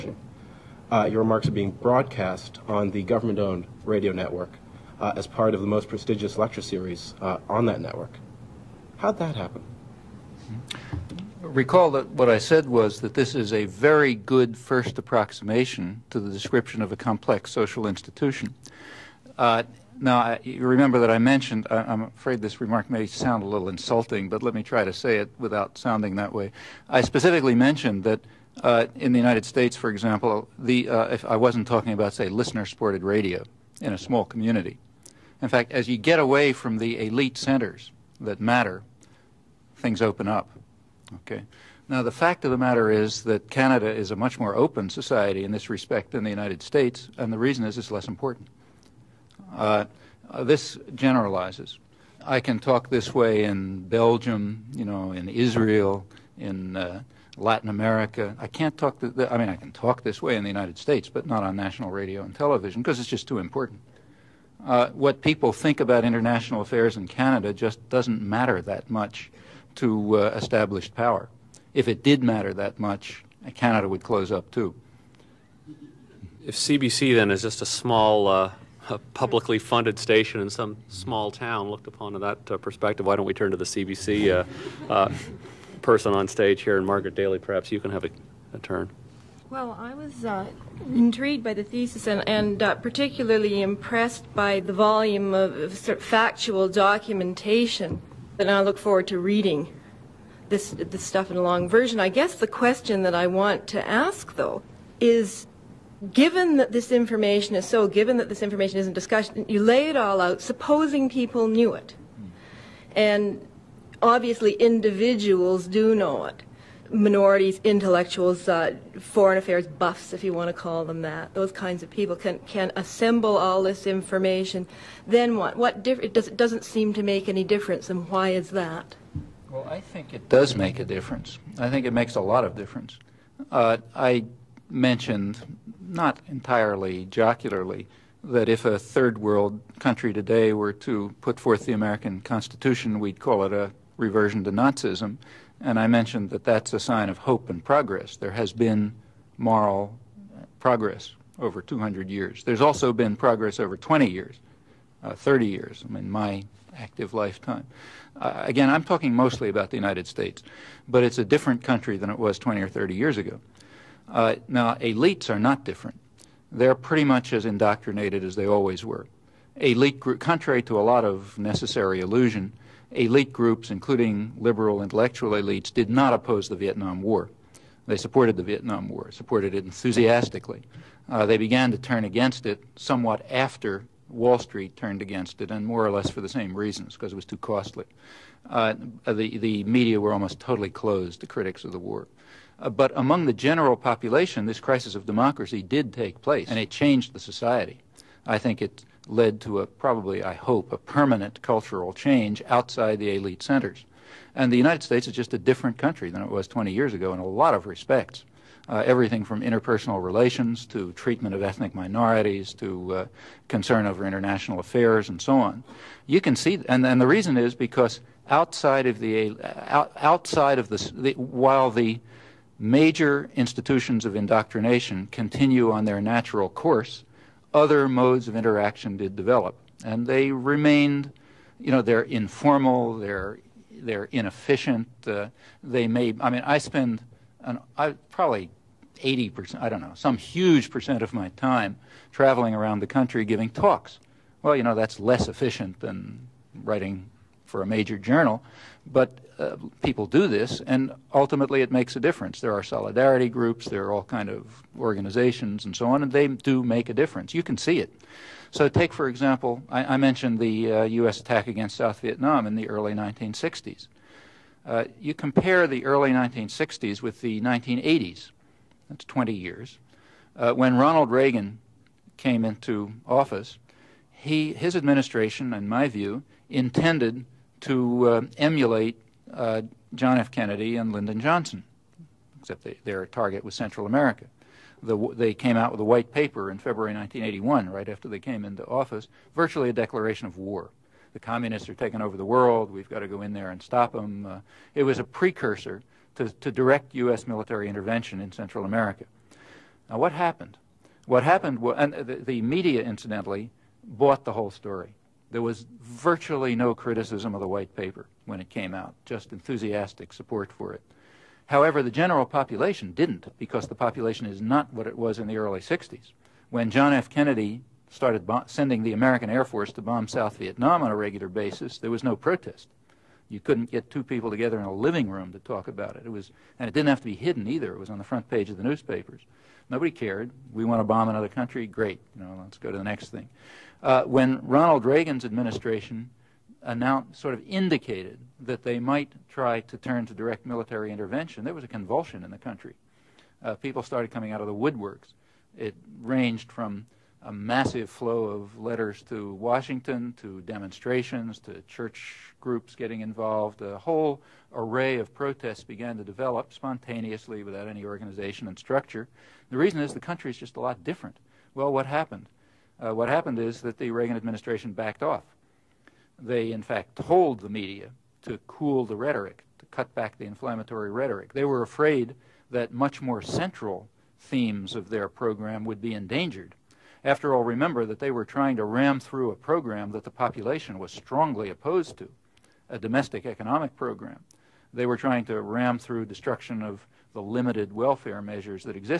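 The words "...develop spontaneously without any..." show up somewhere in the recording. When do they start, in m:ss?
5:56.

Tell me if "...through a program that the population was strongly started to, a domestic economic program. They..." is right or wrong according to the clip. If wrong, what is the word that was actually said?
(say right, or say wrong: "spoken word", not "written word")
wrong: "opposed", not "started".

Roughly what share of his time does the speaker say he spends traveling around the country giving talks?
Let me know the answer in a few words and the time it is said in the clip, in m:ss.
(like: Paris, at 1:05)
80%, at 3:58.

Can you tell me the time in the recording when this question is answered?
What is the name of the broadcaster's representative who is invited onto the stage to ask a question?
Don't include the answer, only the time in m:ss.
1:26.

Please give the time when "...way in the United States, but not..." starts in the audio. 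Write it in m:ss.
1:00.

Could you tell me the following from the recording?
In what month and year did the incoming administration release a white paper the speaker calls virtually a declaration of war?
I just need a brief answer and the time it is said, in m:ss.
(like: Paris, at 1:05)
February 1981, at 4:46.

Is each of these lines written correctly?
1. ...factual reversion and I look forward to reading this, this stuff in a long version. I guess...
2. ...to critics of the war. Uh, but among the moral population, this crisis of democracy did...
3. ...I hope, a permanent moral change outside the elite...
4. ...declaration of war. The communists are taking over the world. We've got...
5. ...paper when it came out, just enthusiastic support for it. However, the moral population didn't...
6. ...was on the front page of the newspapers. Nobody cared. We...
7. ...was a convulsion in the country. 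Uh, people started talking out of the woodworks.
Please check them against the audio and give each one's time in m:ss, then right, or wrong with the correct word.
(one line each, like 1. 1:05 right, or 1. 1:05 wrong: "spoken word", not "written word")
1. 1:36 wrong: "documentation", not "reversion"
2. 3:11 wrong: "general", not "moral"
3. 3:20 wrong: "cultural", not "moral"
4. 4:49 right
5. 5:07 wrong: "general", not "moral"
6. 5:27 right
7. 5:41 wrong: "coming", not "talking".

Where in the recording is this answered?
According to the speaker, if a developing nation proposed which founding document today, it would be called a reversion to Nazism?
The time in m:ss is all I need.
2:21.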